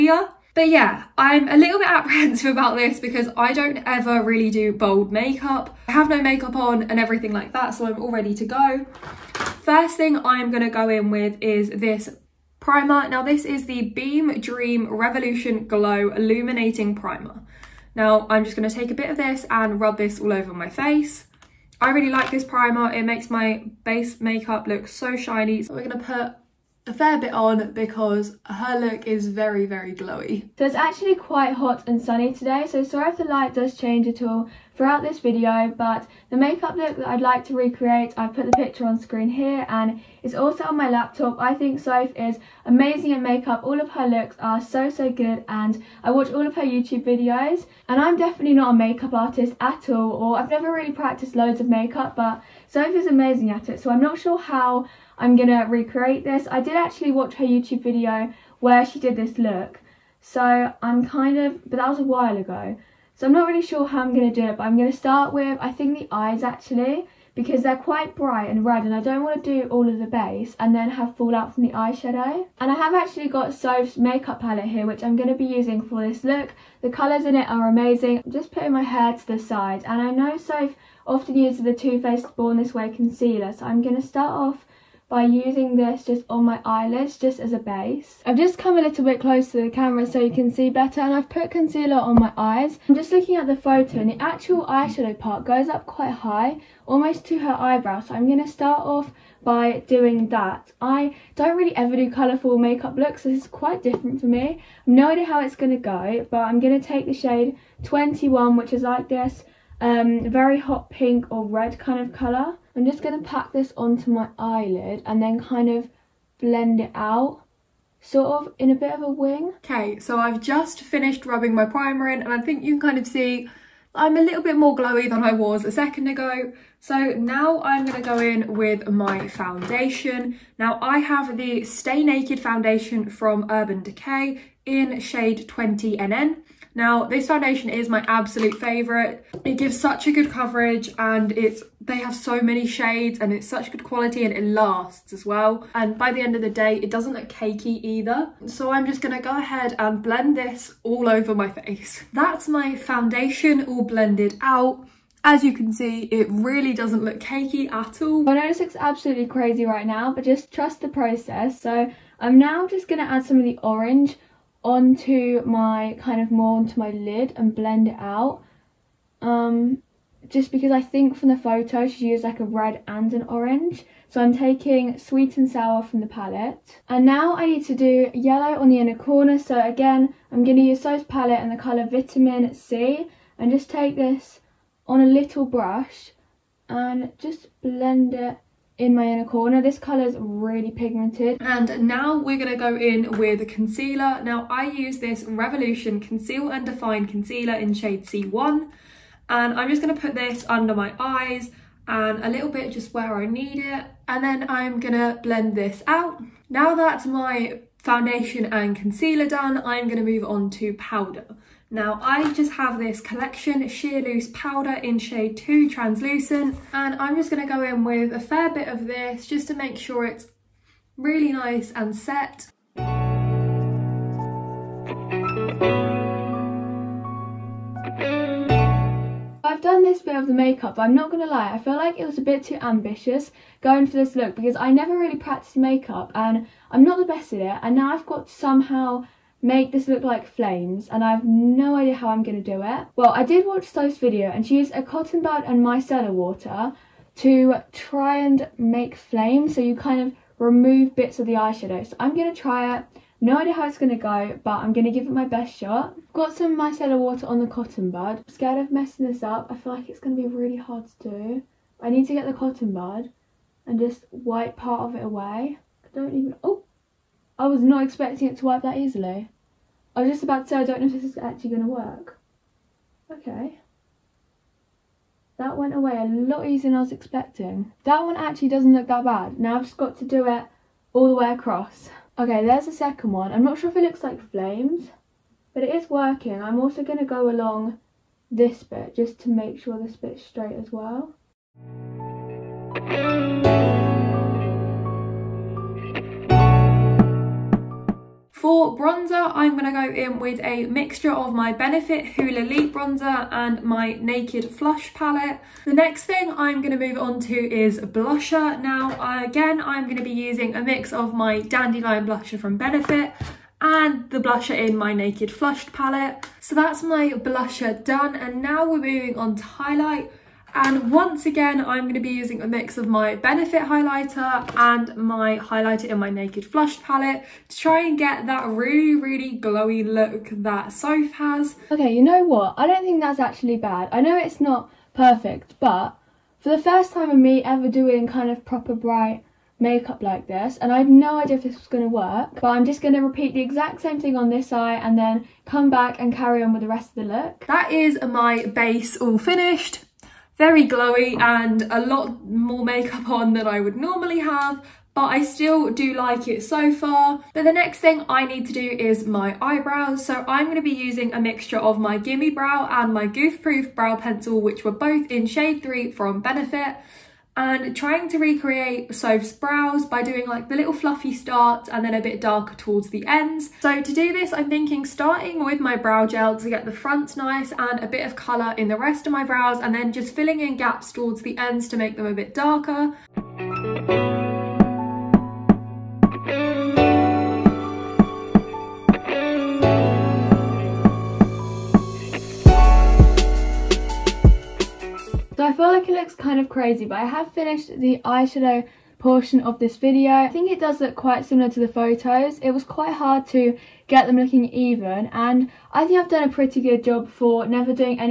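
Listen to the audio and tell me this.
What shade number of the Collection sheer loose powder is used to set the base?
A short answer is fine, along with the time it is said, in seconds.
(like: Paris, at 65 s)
2, at 215 s.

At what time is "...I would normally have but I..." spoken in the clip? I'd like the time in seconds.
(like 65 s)
353 s.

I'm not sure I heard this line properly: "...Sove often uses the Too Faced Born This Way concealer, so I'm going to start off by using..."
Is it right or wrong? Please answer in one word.
right.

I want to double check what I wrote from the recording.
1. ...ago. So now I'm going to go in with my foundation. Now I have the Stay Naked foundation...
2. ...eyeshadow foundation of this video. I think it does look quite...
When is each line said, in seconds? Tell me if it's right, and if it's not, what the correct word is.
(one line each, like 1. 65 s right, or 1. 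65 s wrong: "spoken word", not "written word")
1. 126 s right
2. 398 s wrong: "portion", not "foundation".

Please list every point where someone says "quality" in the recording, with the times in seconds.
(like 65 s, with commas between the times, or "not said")
143 s.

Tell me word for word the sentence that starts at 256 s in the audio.
Got some micellar water on the cotton bud.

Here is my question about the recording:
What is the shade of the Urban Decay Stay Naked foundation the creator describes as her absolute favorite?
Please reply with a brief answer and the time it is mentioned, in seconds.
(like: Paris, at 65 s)
20NN, at 135 s.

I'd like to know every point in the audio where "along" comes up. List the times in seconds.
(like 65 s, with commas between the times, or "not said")
287 s.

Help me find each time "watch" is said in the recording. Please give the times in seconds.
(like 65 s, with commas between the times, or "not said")
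46 s, 57 s, 243 s.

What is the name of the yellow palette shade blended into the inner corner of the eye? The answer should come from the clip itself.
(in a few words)
Vitamin C.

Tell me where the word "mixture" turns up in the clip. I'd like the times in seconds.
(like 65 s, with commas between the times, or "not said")
300 s, 361 s.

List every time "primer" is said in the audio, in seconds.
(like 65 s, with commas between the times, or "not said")
12 s, 16 s, 22 s, 121 s.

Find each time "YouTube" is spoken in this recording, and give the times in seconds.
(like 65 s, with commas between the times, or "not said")
46 s, 57 s.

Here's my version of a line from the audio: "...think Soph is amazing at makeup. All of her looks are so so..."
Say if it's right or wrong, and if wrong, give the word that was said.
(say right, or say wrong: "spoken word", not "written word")
right.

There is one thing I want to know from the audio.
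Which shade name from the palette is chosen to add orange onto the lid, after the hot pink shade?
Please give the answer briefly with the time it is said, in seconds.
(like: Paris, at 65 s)
Sweet and Sour, at 174 s.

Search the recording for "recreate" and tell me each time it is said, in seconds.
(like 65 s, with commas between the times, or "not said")
37 s, 55 s, 368 s.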